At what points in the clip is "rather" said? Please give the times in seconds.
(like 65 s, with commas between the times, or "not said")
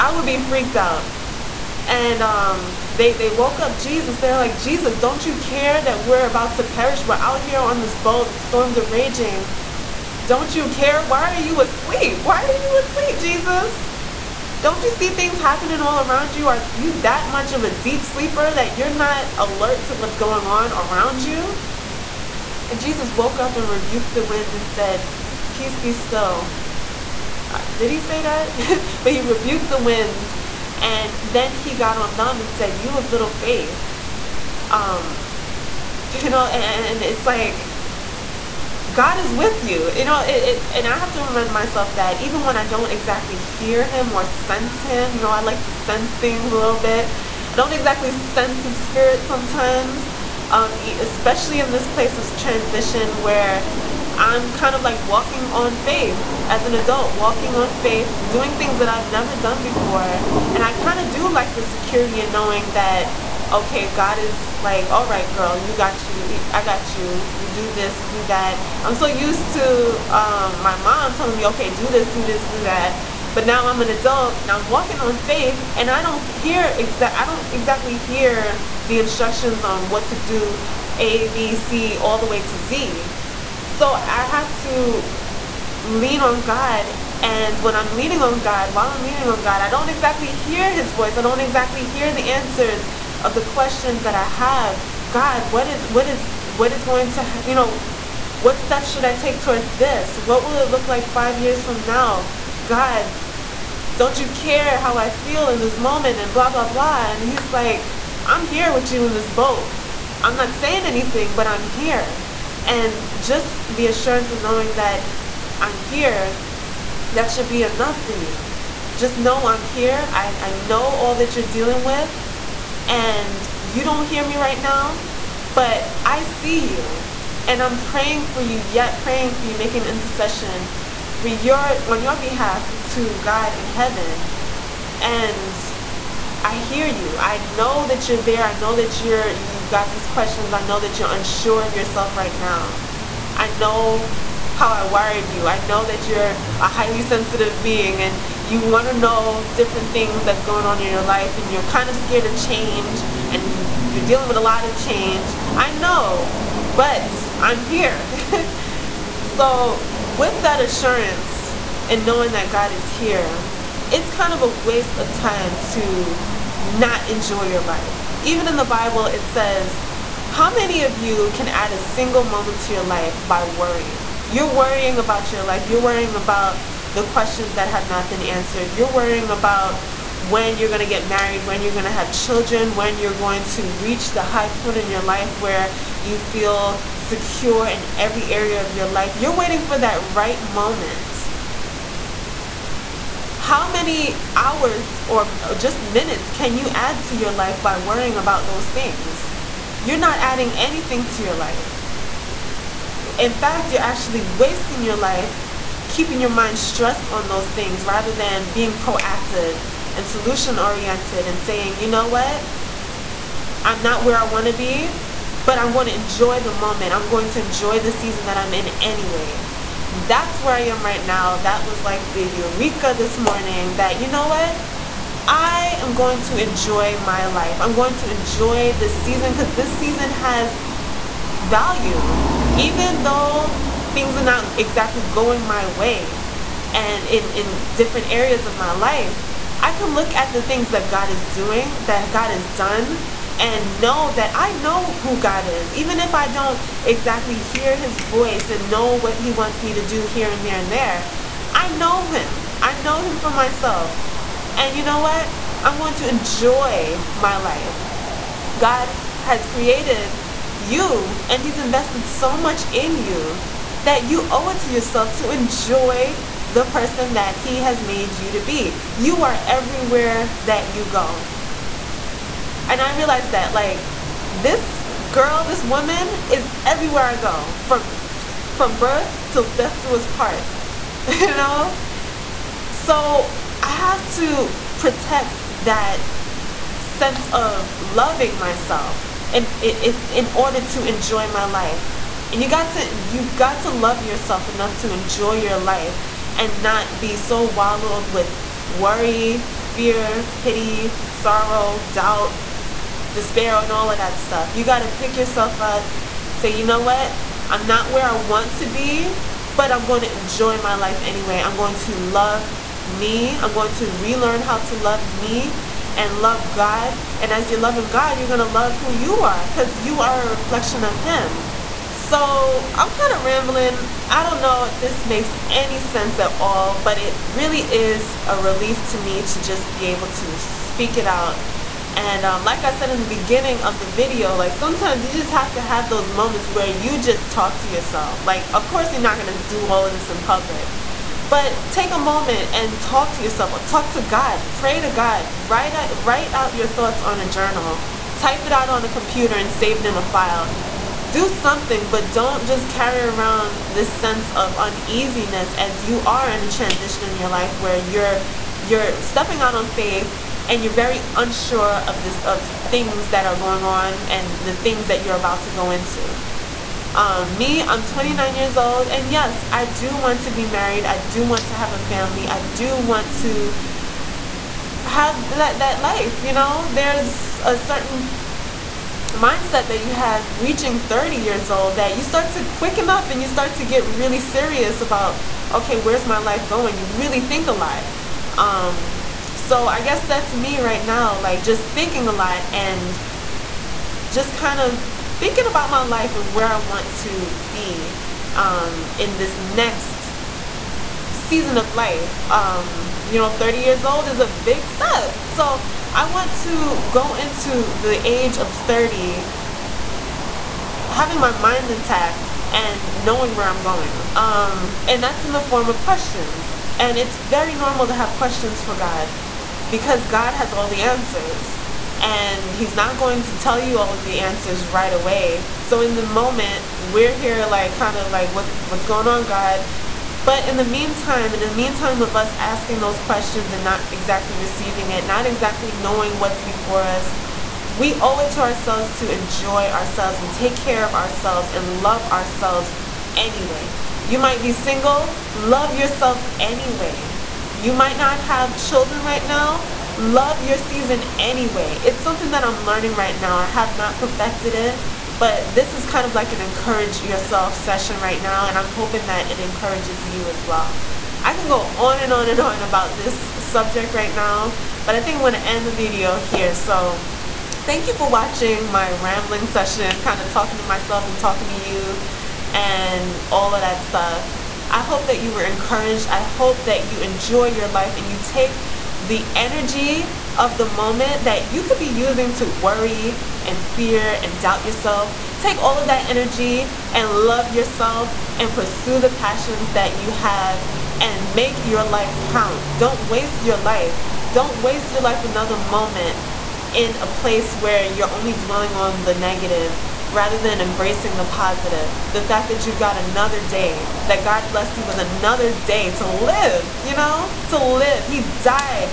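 207 s, 500 s.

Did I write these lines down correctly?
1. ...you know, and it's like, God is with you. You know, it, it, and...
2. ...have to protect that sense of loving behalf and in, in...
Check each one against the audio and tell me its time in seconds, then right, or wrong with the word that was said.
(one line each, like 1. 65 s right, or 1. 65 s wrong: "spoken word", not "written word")
1. 36 s right
2. 283 s wrong: "myself", not "behalf".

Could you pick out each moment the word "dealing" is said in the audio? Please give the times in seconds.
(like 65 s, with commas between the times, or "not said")
121 s, 154 s.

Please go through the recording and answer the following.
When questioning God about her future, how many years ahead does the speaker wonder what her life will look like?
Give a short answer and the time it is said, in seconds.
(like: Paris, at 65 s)
5, at 101 s.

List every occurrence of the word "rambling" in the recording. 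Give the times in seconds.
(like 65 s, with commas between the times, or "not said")
323 s, 468 s.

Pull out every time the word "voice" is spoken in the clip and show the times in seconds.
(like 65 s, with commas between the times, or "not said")
90 s, 247 s.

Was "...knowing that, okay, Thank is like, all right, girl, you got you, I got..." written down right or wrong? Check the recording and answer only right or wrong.
wrong.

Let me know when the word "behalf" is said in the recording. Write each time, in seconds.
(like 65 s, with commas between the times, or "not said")
132 s.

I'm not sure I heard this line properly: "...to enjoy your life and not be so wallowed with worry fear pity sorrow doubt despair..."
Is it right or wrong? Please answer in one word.
right.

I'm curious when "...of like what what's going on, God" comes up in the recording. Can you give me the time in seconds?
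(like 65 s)
427 s.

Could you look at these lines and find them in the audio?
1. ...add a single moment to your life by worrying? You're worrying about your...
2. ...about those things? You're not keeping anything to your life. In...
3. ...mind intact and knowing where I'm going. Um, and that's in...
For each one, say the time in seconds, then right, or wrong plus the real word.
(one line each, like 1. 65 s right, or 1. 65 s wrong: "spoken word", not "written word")
1. 171 s right
2. 198 s wrong: "adding", not "keeping"
3. 411 s right.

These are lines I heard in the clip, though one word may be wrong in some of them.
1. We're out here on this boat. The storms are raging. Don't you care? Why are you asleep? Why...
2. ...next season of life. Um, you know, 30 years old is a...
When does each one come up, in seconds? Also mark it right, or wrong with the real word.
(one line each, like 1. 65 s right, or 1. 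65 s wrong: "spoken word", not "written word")
1. 7 s right
2. 399 s right.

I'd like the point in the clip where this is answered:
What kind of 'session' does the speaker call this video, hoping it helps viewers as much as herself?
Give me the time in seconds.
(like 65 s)
456 s.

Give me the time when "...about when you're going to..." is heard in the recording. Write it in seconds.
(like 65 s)
179 s.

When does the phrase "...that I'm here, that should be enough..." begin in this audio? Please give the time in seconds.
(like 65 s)
114 s.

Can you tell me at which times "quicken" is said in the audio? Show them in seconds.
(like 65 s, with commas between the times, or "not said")
382 s.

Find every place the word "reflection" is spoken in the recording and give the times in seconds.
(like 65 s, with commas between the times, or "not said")
320 s.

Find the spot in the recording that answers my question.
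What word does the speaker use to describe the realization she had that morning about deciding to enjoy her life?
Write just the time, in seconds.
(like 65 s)
222 s.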